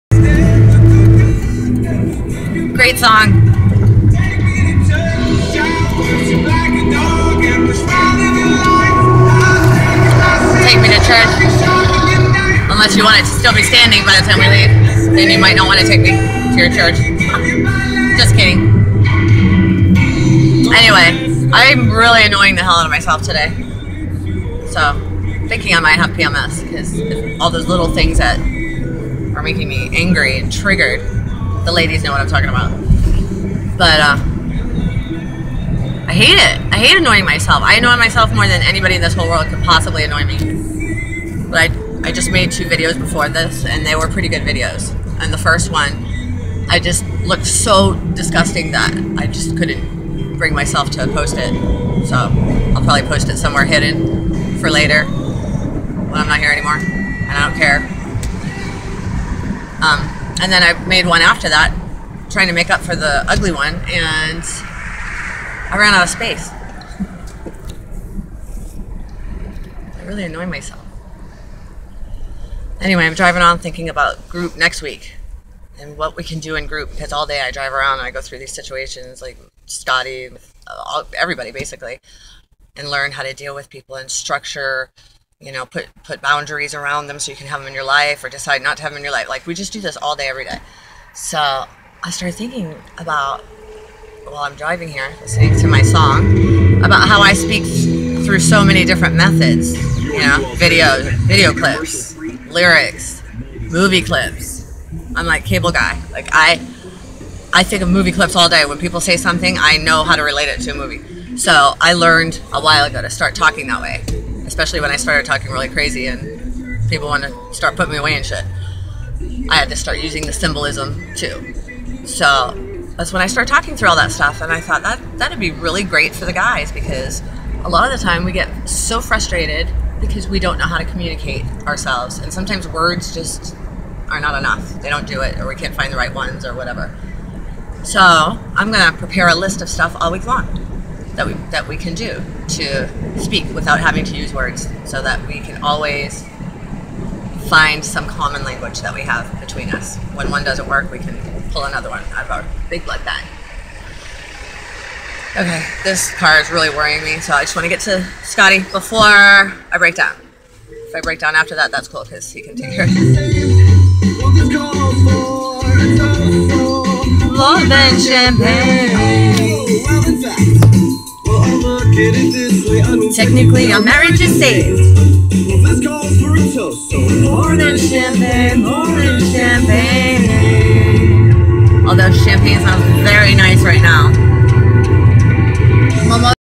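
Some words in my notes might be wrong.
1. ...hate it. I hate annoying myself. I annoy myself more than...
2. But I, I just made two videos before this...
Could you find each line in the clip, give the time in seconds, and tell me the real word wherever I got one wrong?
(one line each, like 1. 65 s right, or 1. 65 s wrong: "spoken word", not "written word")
1. 36 s right
2. 41 s right.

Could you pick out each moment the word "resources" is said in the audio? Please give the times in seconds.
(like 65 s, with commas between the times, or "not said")
not said.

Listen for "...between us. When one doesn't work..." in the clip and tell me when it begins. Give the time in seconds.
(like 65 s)
149 s.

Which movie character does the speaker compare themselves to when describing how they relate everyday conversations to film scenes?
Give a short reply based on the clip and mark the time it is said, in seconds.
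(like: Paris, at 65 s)
Cable Guy, at 105 s.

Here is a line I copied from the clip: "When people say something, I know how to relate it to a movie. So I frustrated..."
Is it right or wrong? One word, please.
wrong.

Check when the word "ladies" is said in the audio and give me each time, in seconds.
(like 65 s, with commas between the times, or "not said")
31 s.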